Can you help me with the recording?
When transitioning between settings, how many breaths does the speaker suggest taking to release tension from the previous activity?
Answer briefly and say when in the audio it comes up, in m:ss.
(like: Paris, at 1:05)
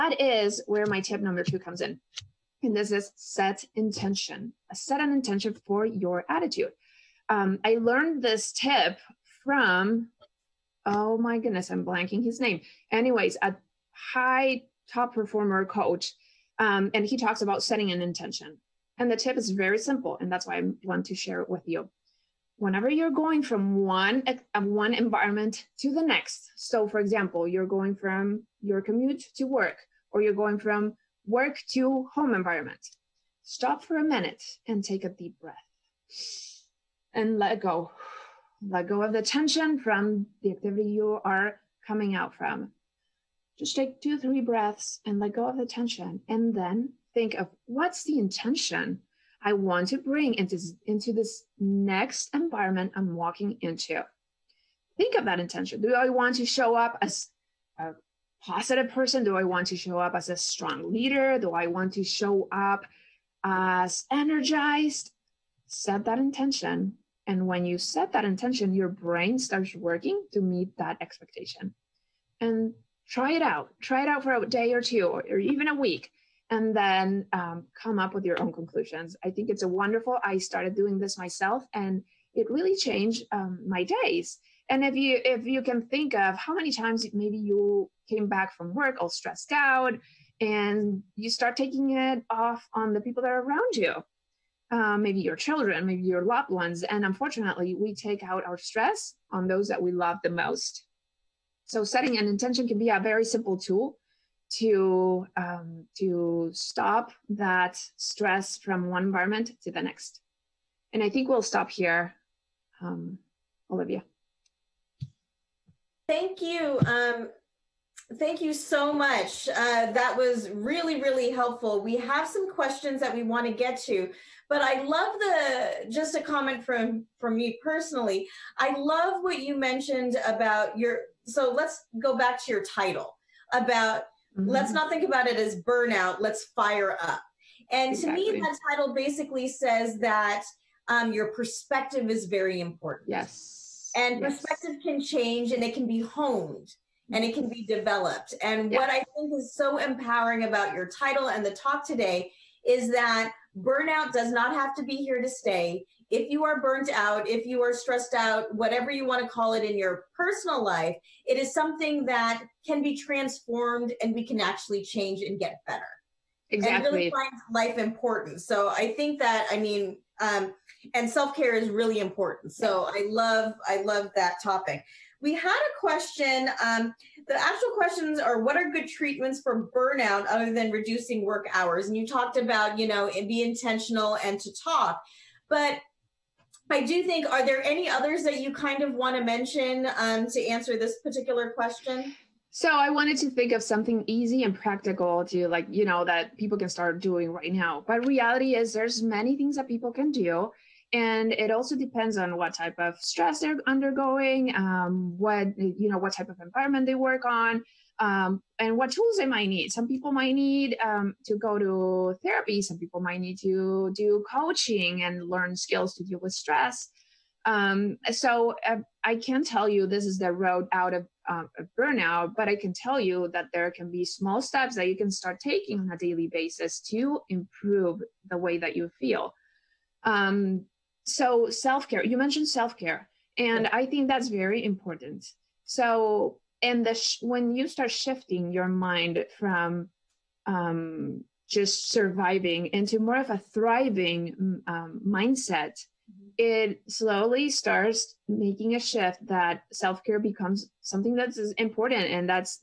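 2 or 3, at 0:44.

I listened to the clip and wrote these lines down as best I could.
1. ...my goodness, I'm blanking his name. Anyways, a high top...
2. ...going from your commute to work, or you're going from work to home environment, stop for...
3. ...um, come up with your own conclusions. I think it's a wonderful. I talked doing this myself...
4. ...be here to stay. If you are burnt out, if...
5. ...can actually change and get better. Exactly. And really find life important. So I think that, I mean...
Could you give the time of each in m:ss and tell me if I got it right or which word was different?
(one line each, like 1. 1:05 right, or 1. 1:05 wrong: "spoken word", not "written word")
1. 0:11 right
2. 0:27 right
3. 1:17 wrong: "started", not "talked"
4. 2:34 right
5. 2:44 right.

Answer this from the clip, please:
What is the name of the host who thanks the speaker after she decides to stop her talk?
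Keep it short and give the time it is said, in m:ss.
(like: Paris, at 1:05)
Olivia, at 1:53.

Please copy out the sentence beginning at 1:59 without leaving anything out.
Uh, that was really, really helpful.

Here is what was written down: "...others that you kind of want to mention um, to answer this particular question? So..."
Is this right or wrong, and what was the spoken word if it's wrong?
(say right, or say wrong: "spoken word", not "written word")
right.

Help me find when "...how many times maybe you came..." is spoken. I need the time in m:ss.
1:26.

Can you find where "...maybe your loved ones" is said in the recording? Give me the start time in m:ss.
1:35.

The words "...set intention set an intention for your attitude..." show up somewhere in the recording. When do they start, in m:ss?
0:03.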